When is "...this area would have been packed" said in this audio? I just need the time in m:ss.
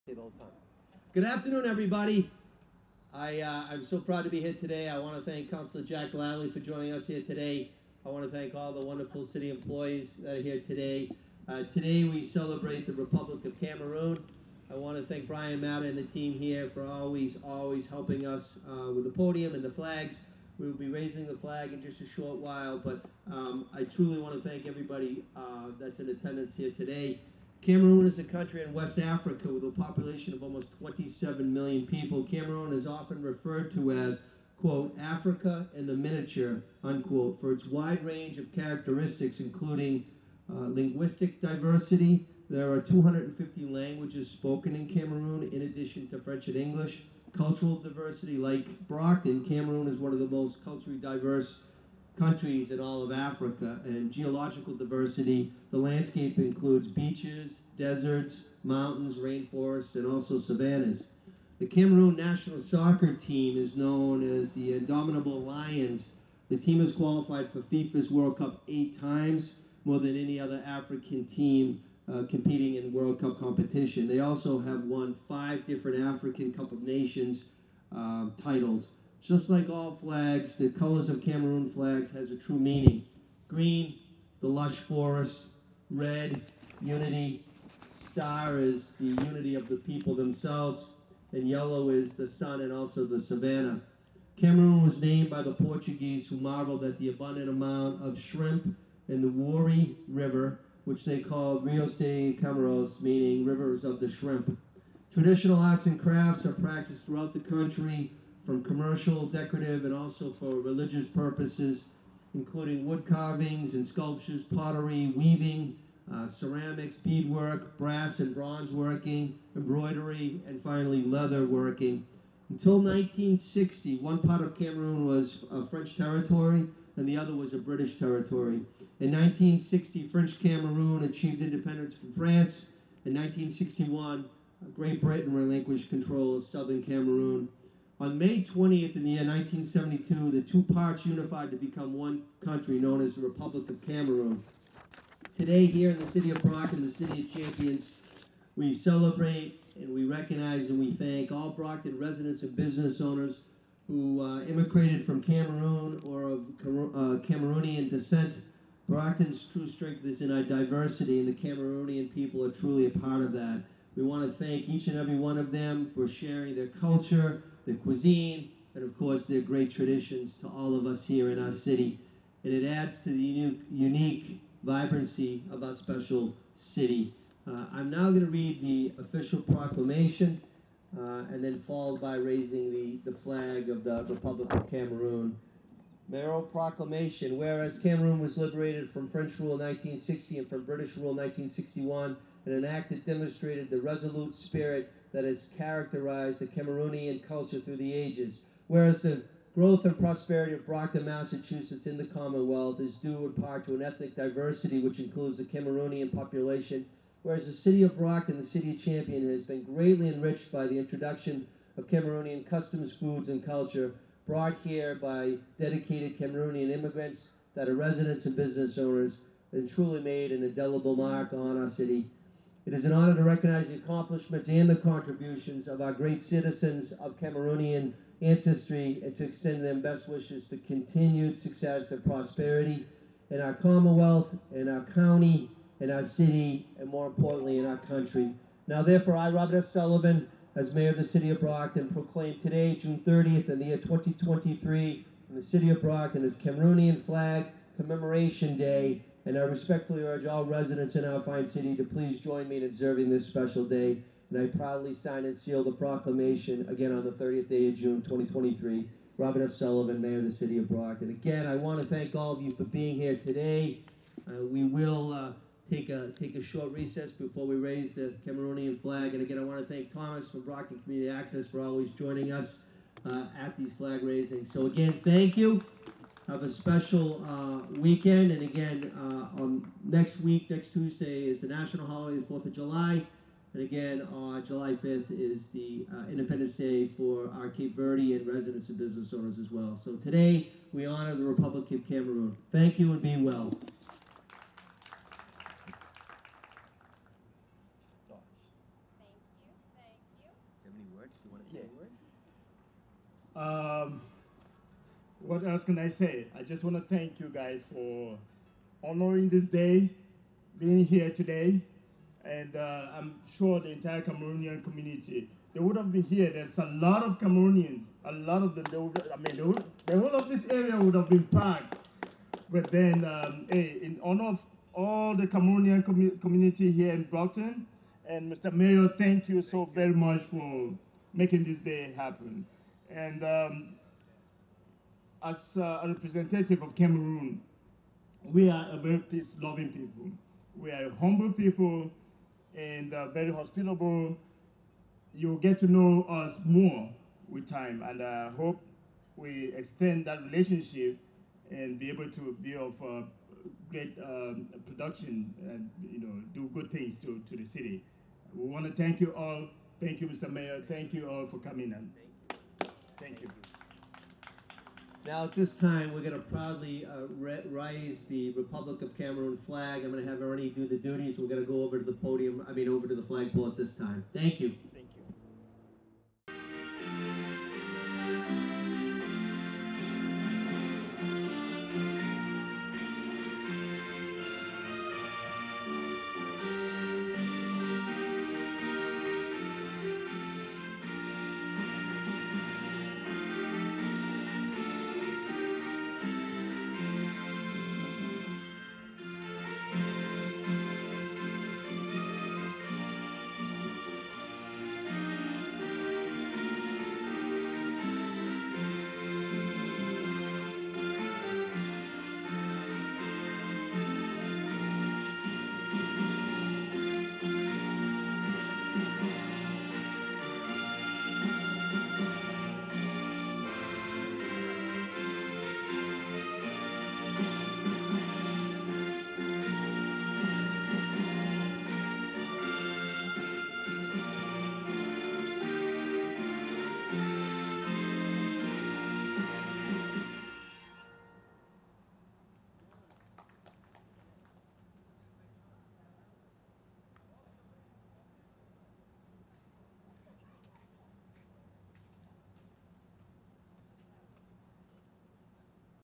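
5:20.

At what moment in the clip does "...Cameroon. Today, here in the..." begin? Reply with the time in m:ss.
2:23.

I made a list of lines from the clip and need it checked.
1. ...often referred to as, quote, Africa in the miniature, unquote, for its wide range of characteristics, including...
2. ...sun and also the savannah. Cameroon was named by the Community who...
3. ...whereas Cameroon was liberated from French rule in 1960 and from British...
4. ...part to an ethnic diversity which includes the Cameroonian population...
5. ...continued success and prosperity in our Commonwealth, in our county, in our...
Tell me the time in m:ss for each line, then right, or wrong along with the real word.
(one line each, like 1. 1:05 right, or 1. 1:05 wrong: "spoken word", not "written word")
1. 0:32 right
2. 1:32 wrong: "Portuguese", not "Community"
3. 3:07 right
4. 3:23 right
5. 3:50 right.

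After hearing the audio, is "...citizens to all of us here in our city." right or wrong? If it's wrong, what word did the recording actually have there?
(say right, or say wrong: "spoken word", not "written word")
wrong: "traditions", not "citizens".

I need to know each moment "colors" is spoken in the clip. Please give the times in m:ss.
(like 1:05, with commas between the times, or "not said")
1:20.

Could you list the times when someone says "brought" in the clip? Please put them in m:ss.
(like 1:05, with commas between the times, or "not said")
3:34.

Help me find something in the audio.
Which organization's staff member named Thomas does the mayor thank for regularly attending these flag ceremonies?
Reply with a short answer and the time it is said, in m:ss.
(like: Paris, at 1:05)
Brockton Community Access, at 4:30.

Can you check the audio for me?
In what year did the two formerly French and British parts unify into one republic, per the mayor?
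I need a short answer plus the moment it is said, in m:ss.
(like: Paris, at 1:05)
1972, at 2:19.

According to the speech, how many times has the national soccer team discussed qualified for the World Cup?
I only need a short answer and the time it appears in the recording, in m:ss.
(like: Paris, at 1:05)
8, at 1:08.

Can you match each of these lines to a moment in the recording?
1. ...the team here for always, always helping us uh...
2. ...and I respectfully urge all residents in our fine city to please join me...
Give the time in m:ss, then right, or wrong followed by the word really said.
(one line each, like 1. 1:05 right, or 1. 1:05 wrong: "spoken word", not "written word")
1. 0:15 right
2. 4:09 right.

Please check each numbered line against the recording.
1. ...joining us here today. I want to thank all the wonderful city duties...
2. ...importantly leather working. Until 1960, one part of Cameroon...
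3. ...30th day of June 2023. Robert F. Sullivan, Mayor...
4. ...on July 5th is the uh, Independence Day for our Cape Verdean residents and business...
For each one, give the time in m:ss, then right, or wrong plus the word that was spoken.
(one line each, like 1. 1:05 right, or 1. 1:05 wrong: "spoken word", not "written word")
1. 0:06 wrong: "employees", not "duties"
2. 2:00 wrong: "finally", not "importantly"
3. 4:17 right
4. 4:44 right.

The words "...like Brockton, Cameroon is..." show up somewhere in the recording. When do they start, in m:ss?
0:48.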